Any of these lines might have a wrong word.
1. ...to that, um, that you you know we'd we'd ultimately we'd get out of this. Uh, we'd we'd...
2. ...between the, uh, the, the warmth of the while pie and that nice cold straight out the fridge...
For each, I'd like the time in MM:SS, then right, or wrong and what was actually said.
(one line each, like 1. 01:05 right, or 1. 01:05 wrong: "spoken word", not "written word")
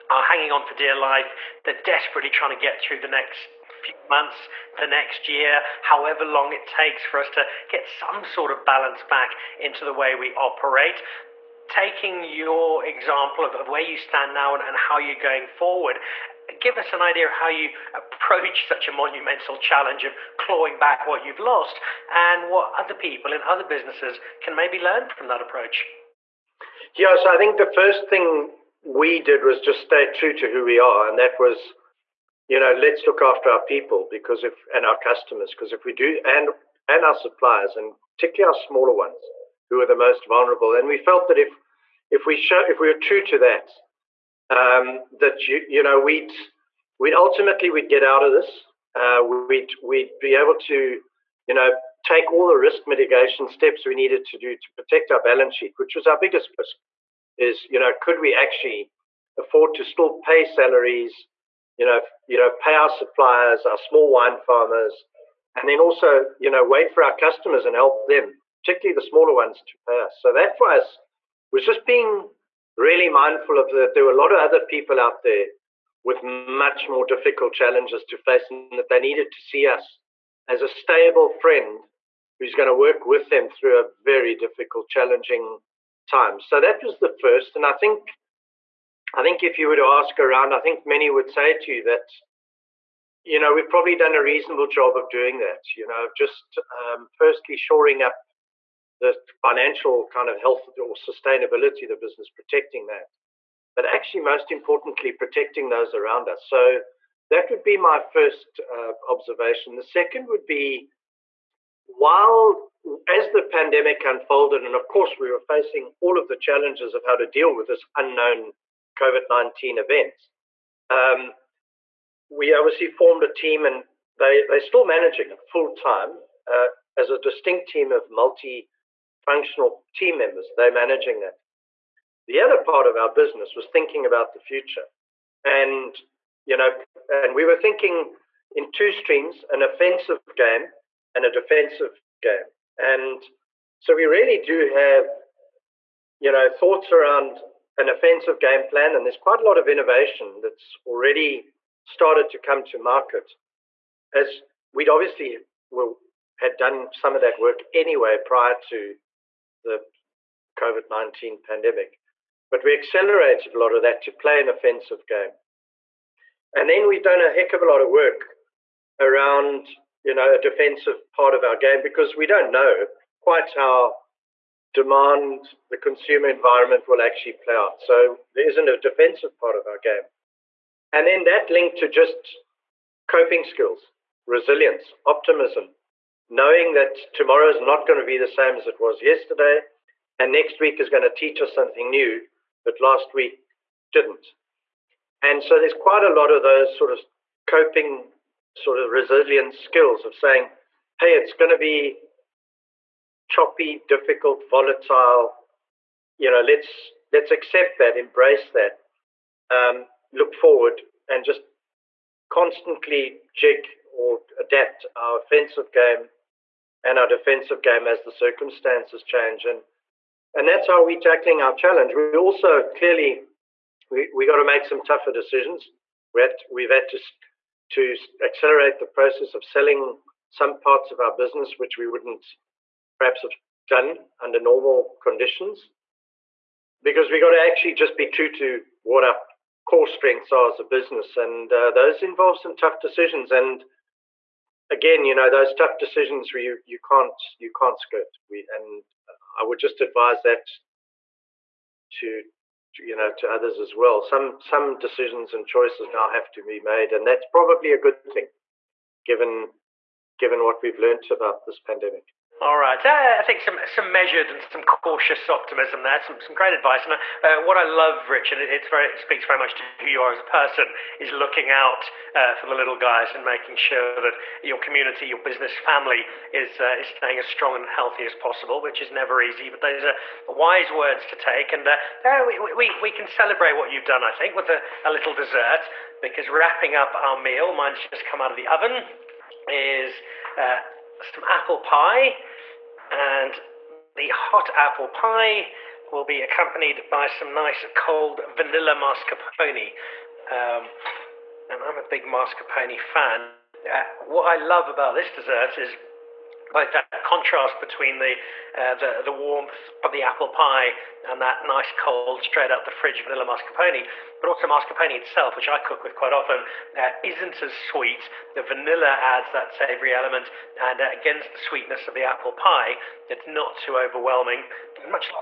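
1. 00:43 right
2. 05:07 wrong: "apple", not "while".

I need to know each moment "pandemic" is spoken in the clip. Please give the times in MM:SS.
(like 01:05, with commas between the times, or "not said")
01:53, 02:41, 04:21.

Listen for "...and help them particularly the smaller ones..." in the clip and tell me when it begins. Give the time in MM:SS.
01:07.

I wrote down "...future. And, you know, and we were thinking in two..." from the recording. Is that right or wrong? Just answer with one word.
right.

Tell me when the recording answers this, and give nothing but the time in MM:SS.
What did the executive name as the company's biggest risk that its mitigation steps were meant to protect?
00:55.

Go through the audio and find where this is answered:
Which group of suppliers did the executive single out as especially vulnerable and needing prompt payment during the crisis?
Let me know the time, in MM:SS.
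01:03.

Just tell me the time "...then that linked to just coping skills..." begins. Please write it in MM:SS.
03:01.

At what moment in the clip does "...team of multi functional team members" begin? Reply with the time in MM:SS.
02:07.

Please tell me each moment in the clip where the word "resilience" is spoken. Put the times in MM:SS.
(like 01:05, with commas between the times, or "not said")
03:04, 03:18.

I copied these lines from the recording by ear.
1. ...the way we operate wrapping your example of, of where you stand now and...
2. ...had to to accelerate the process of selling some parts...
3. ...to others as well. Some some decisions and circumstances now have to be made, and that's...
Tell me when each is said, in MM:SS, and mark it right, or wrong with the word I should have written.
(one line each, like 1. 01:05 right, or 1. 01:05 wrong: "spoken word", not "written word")
1. 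00:09 wrong: "taking", not "wrapping"
2. 03:46 right
3. 04:13 wrong: "choices", not "circumstances".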